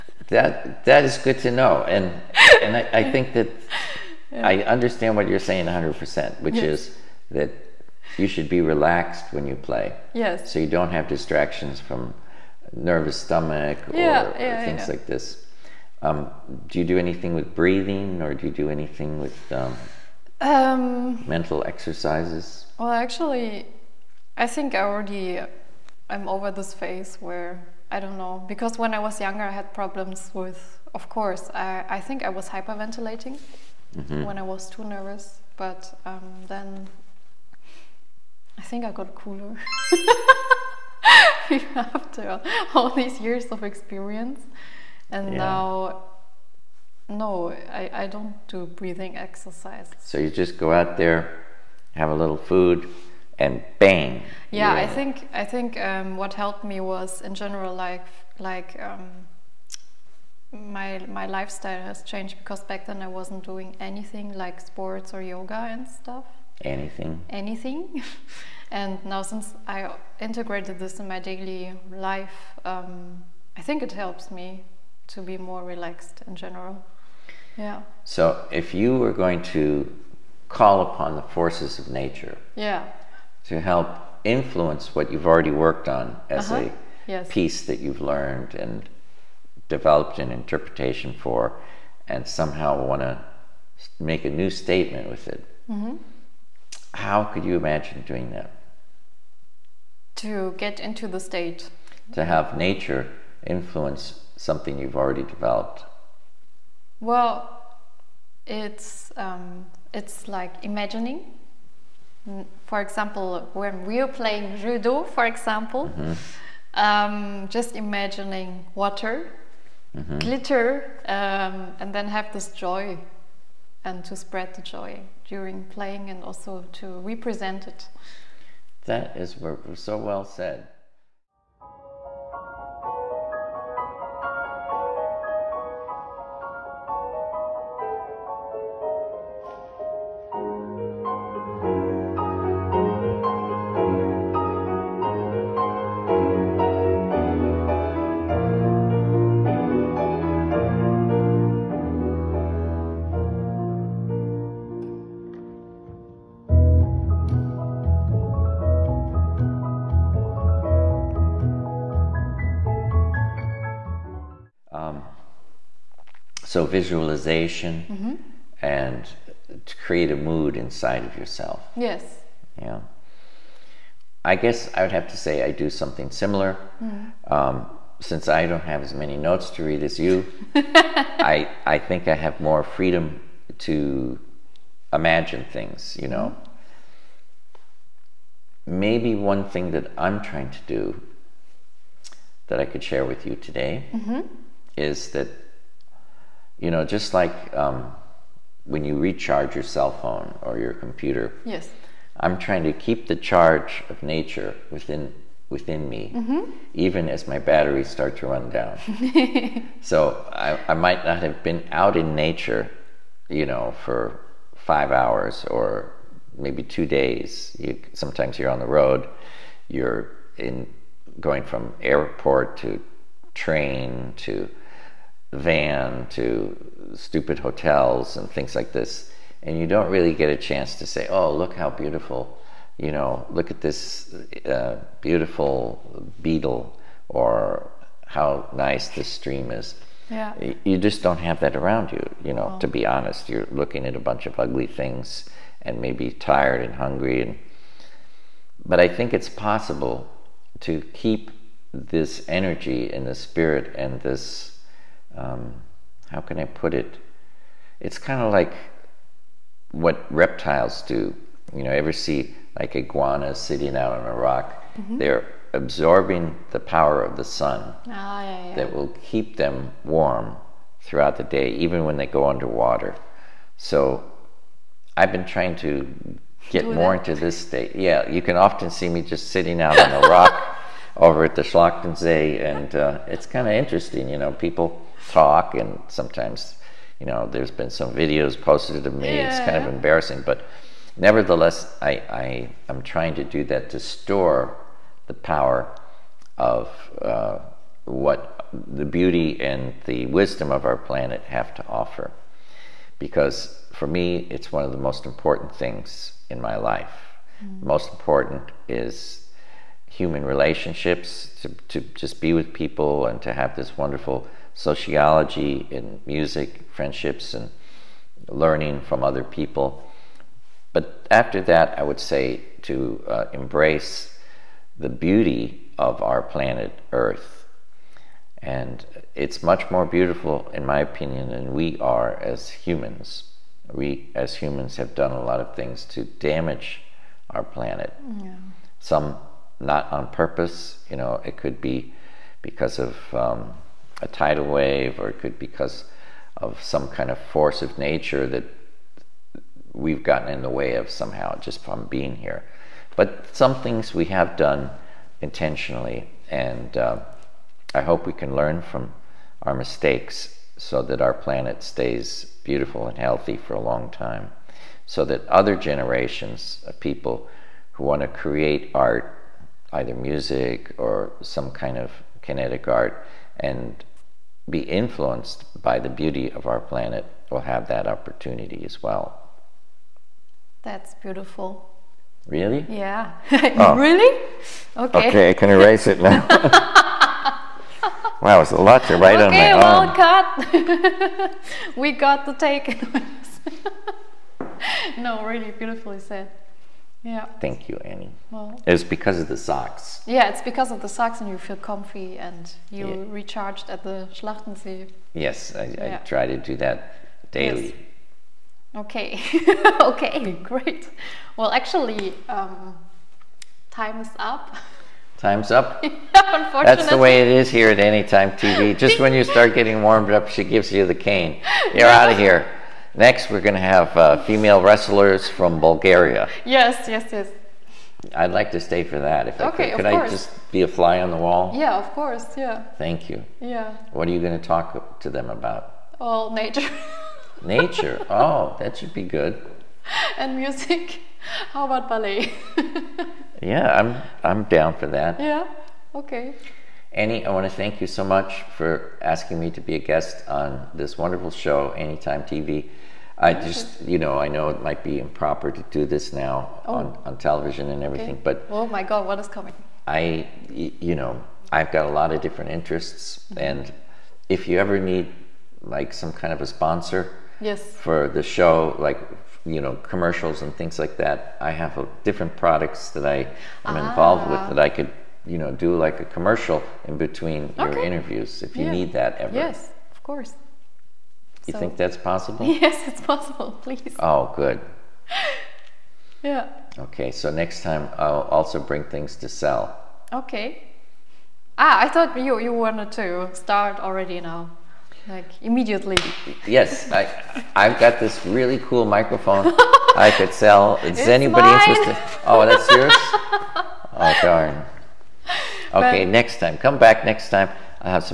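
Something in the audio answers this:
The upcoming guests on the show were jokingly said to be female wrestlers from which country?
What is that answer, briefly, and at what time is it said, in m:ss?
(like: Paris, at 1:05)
Bulgaria, at 7:05.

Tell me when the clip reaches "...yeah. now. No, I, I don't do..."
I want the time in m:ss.
0:45.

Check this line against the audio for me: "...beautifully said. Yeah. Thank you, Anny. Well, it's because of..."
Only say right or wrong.
right.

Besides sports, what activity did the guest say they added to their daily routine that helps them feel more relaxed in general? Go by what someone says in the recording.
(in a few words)
yoga.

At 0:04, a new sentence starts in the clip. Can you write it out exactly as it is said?
I understand what you're saying 100, percent which yes.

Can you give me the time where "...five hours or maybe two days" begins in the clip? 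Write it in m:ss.
3:34.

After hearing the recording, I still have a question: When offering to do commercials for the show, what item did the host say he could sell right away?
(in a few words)
microphone.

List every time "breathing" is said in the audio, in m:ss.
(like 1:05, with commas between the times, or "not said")
0:17, 0:48.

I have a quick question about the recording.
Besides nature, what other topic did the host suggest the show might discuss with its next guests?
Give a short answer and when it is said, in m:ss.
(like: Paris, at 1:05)
ballet, at 7:21.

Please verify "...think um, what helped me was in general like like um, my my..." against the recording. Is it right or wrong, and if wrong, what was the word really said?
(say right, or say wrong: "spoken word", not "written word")
right.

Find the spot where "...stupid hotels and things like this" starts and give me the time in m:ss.
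3:46.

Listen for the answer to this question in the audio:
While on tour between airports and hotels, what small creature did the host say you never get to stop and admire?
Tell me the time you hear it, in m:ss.
3:56.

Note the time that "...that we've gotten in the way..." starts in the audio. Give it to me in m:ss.
5:48.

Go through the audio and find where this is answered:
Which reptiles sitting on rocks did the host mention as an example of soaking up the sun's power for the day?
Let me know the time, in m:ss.
4:22.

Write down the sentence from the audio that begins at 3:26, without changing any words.
even as my batteries start to run down.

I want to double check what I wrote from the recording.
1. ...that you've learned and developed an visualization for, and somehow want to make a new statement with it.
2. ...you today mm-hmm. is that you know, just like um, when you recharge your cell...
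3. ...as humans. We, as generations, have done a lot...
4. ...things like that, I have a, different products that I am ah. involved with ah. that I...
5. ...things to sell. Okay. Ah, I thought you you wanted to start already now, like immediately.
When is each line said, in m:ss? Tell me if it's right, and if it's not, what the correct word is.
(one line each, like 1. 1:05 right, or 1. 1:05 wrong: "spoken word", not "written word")
1. 1:27 wrong: "interpretation", not "visualization"
2. 3:13 right
3. 5:32 wrong: "humans", not "generations"
4. 7:50 right
5. 8:08 right.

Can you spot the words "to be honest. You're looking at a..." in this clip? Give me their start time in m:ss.
4:02.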